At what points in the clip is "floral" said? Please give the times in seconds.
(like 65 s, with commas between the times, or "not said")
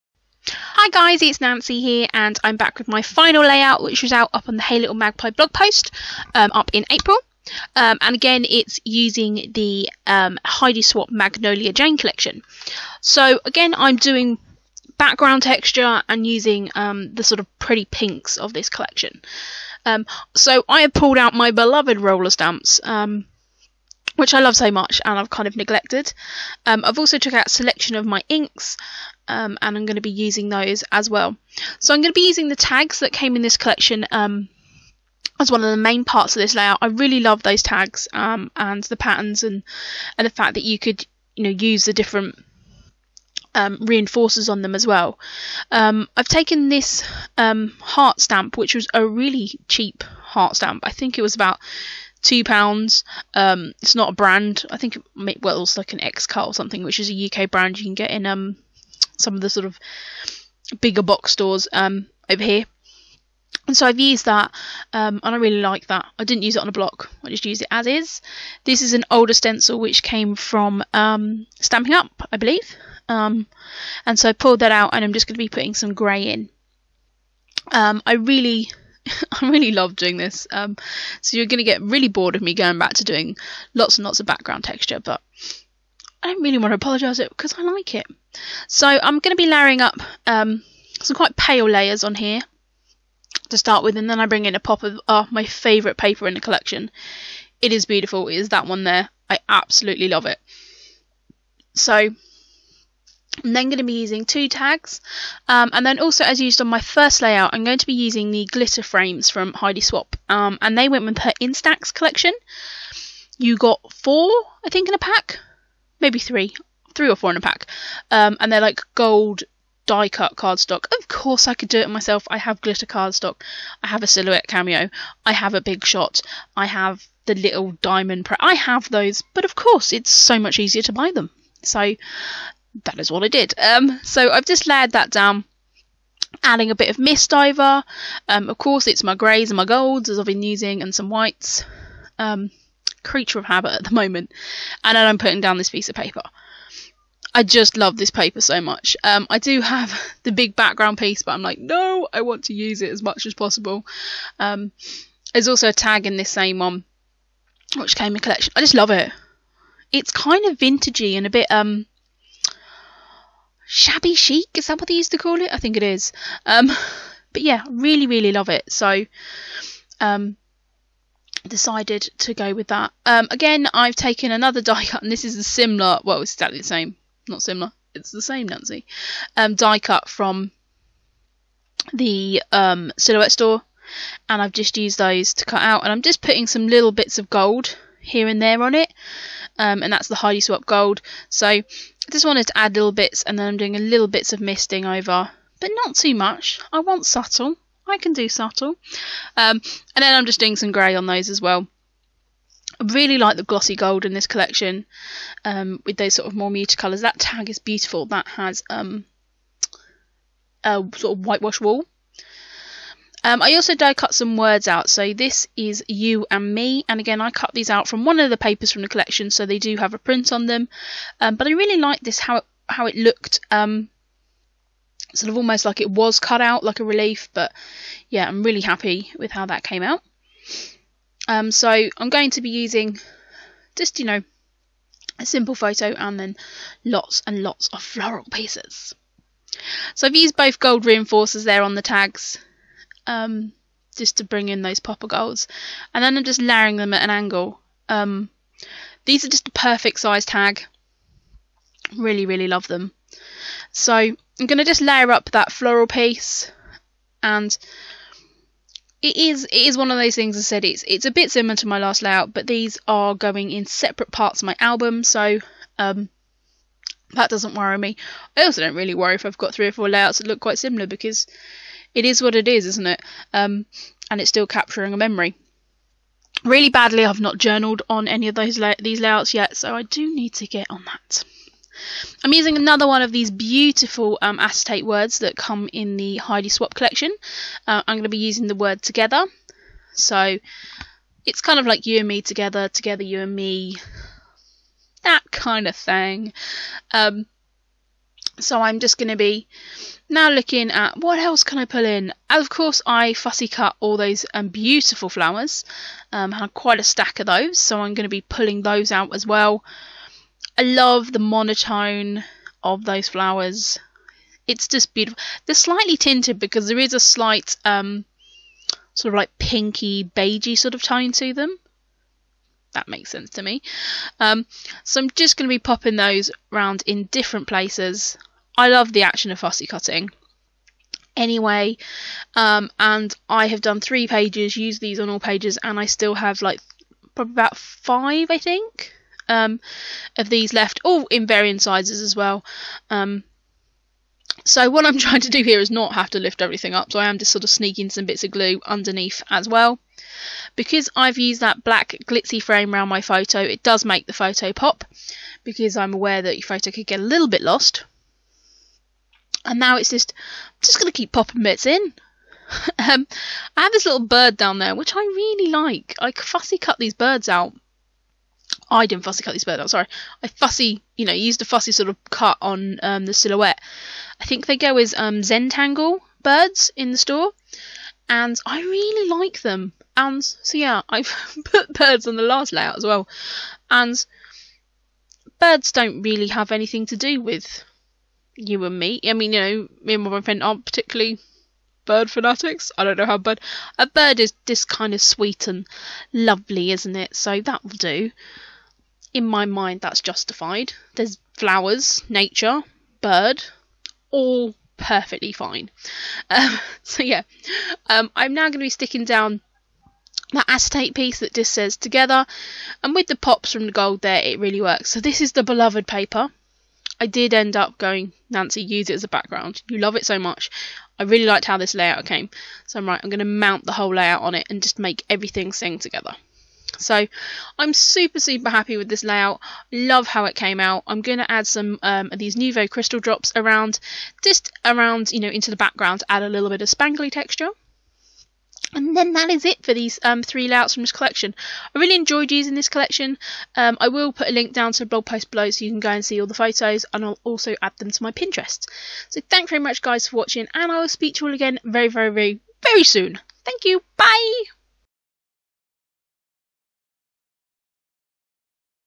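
237 s, 255 s.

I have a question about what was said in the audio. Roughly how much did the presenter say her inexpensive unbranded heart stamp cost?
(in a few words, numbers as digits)
2 pounds.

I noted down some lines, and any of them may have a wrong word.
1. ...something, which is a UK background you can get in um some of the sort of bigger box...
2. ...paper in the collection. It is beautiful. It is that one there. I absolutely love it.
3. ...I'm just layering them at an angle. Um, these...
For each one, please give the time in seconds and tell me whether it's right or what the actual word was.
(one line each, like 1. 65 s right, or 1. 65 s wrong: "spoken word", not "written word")
1. 56 s wrong: "brand", not "background"
2. 95 s right
3. 246 s right.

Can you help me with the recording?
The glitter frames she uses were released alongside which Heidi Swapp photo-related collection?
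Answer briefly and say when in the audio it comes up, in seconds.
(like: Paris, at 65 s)
Instax, at 111 s.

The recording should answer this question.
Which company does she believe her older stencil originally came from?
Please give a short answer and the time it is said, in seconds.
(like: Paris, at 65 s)
Stampin' Up, at 71 s.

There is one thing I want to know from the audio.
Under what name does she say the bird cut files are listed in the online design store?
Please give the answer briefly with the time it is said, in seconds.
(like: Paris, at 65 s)
Zentangle birds, at 375 s.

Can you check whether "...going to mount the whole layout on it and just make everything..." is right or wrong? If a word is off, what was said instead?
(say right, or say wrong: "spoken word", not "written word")
right.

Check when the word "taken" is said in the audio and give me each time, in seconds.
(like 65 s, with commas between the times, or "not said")
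46 s, 173 s.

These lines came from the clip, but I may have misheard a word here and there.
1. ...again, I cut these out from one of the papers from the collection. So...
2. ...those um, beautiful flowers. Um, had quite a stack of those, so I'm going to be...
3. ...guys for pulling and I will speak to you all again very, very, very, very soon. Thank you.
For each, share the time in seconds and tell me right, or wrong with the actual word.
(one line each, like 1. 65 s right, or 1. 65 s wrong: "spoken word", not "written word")
1. 216 s right
2. 303 s right
3. 449 s wrong: "watching", not "pulling".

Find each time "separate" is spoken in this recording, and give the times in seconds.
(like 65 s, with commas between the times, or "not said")
263 s.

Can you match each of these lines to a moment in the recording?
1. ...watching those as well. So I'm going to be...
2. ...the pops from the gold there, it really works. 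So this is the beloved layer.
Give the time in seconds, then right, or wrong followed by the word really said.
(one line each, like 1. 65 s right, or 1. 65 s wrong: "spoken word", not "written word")
1. 30 s wrong: "using", not "watching"
2. 413 s wrong: "paper", not "layer".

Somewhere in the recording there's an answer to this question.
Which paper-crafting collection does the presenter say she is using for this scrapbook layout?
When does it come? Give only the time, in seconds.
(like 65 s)
11 s.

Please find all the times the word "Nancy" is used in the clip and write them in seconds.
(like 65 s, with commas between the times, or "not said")
1 s, 178 s, 418 s.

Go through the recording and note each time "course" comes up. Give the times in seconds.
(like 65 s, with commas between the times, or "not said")
121 s, 129 s, 138 s, 302 s.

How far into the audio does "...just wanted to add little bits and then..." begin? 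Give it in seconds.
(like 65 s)
192 s.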